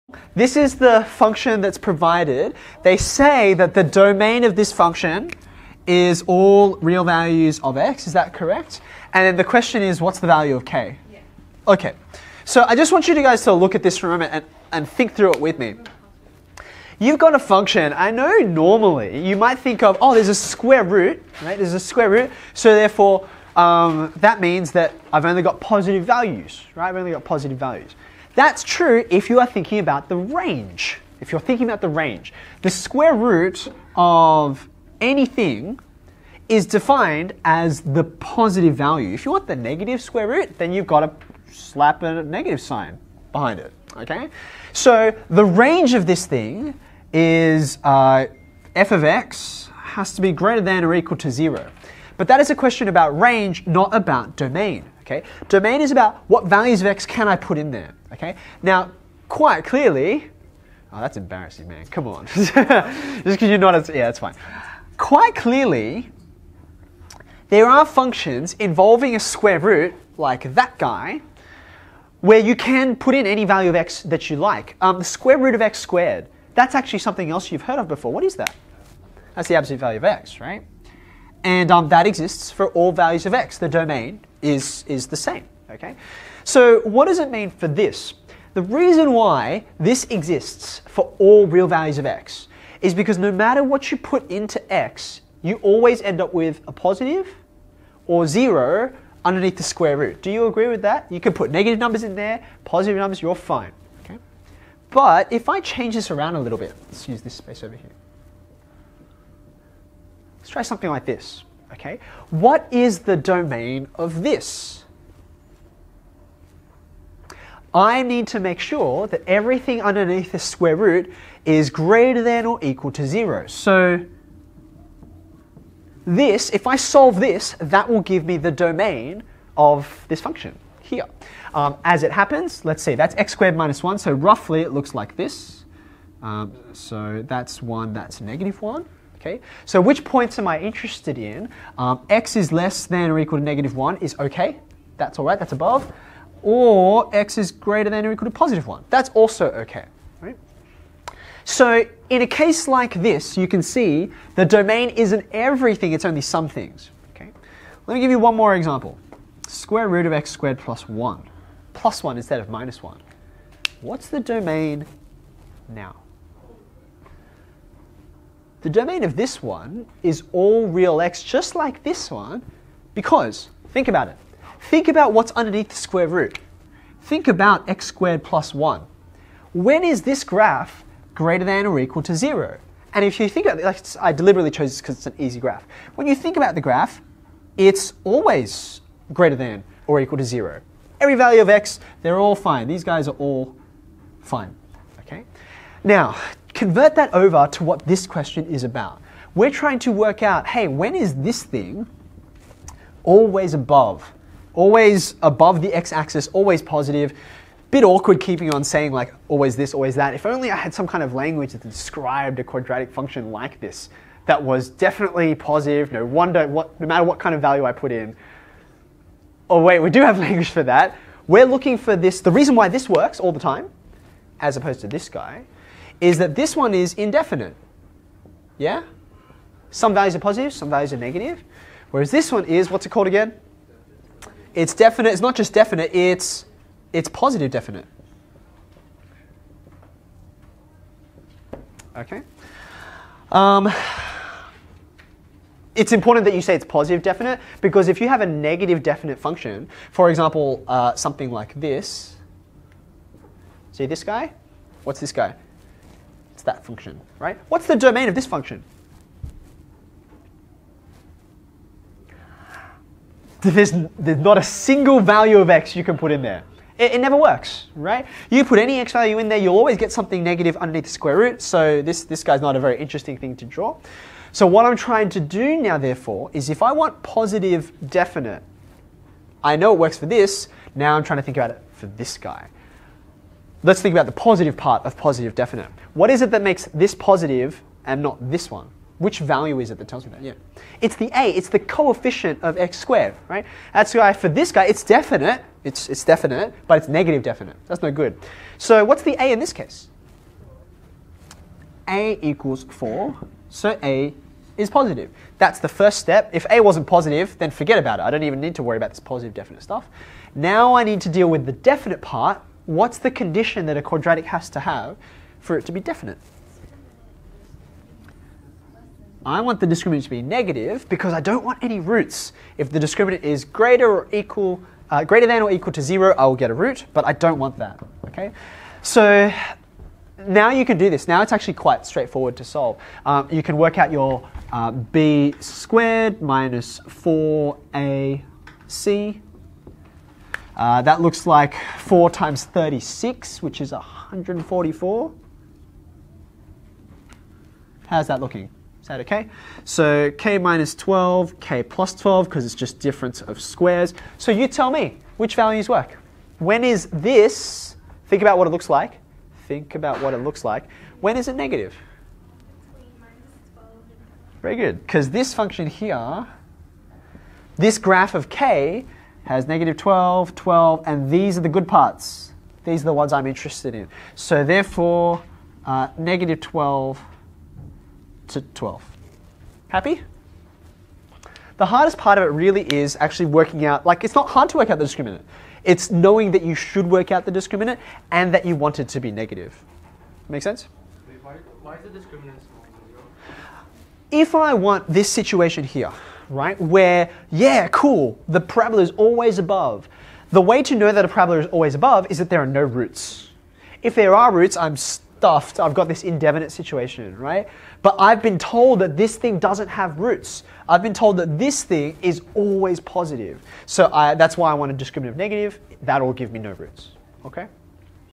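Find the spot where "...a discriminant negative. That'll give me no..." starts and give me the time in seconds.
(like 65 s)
414 s.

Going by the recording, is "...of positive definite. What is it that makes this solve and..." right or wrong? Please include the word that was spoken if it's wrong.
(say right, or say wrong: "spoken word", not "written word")
wrong: "positive", not "solve".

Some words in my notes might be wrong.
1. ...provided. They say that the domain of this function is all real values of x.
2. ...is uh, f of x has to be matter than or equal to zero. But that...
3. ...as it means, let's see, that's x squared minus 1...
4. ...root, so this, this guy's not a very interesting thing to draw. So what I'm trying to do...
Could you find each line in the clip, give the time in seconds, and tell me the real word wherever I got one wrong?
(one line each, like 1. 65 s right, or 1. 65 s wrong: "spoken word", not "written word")
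1. 1 s right
2. 47 s wrong: "greater", not "matter"
3. 131 s wrong: "happens", not "means"
4. 271 s right.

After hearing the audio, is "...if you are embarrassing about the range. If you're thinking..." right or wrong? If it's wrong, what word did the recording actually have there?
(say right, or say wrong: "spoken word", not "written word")
wrong: "thinking", not "embarrassing".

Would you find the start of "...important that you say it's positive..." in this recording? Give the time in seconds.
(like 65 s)
245 s.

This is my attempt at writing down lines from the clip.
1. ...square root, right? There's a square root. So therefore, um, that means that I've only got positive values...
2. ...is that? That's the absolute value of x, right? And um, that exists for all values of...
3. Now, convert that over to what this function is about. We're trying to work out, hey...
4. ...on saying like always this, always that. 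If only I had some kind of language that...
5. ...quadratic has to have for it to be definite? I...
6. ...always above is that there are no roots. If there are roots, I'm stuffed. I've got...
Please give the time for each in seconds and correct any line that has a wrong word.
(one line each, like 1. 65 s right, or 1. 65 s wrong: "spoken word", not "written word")
1. 20 s right
2. 78 s right
3. 195 s wrong: "question", not "function"
4. 208 s right
5. 313 s right
6. 401 s right.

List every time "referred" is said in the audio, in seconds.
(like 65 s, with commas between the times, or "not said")
not said.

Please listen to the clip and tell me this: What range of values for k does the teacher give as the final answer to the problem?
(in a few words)
-12 to 12.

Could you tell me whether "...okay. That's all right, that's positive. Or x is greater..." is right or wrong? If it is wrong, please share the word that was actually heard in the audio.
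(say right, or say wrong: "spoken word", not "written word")
wrong: "above", not "positive".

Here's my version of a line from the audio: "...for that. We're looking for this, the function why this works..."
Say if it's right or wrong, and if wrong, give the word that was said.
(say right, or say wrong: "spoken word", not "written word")
wrong: "reason", not "function".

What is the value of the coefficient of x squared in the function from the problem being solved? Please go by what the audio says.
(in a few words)
4.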